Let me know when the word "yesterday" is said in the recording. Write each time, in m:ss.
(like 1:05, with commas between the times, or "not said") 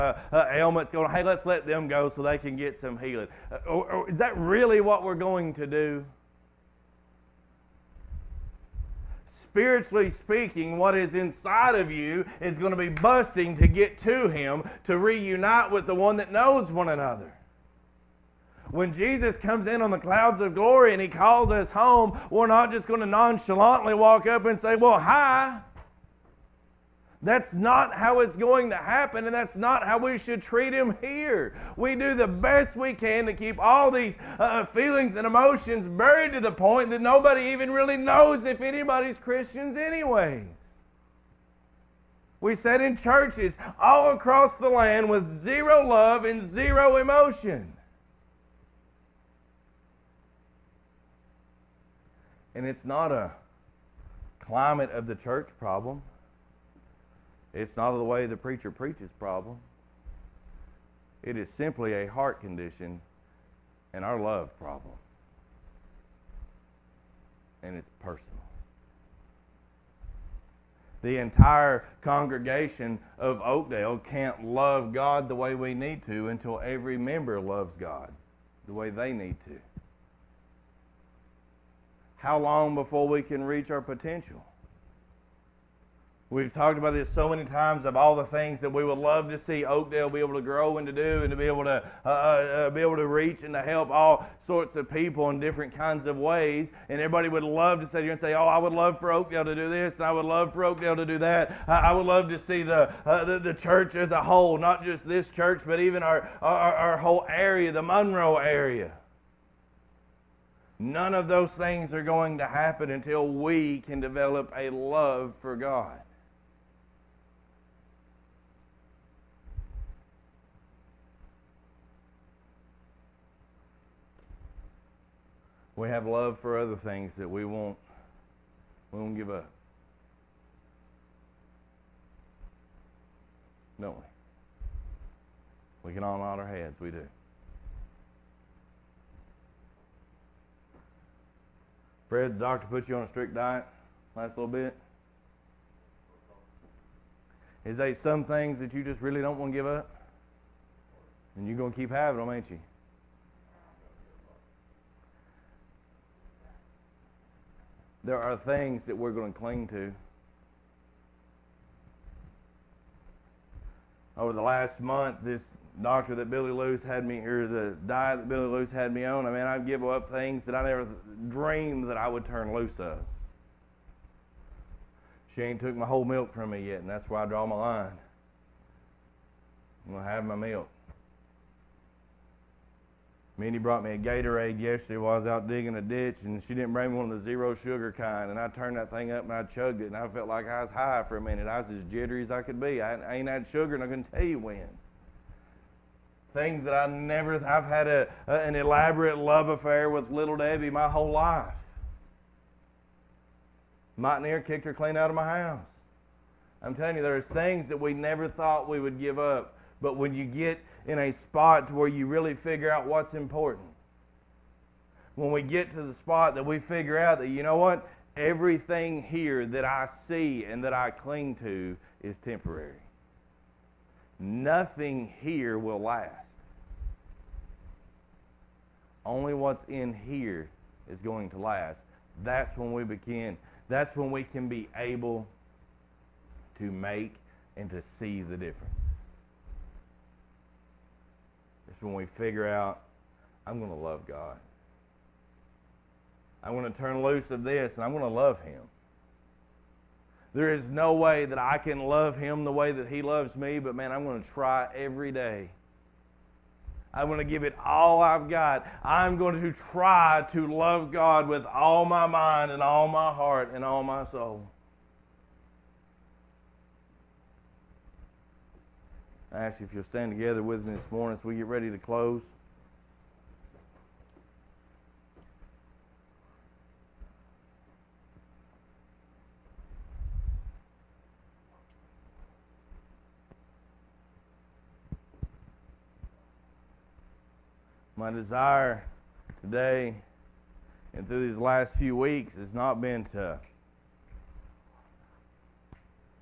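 3:04.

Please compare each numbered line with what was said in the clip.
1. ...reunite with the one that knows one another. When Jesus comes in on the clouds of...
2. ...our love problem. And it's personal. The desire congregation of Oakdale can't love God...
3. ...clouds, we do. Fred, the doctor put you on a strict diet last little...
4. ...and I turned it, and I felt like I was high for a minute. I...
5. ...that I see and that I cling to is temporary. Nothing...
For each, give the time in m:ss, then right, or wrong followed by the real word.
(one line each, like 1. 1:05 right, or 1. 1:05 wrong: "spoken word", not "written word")
1. 0:14 right
2. 1:04 wrong: "entire", not "desire"
3. 2:16 wrong: "heads", not "clouds"
4. 3:09 wrong: "chugged", not "turned"
5. 3:39 right.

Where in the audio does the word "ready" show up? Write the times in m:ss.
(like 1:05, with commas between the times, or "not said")
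4:31.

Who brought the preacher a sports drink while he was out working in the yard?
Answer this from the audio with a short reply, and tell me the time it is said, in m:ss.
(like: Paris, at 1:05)
Mindy, at 3:03.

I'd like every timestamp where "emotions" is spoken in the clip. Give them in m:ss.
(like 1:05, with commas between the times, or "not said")
0:35, 0:46.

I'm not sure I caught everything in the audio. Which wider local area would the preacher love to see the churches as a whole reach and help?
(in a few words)
Monroe.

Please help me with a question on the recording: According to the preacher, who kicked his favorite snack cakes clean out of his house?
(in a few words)
Mike Neer.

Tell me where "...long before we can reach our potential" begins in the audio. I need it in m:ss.
1:22.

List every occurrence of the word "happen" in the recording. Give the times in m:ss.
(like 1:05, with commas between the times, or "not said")
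0:28, 1:52.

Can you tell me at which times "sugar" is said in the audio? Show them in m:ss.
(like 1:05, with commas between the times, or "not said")
3:07, 3:13.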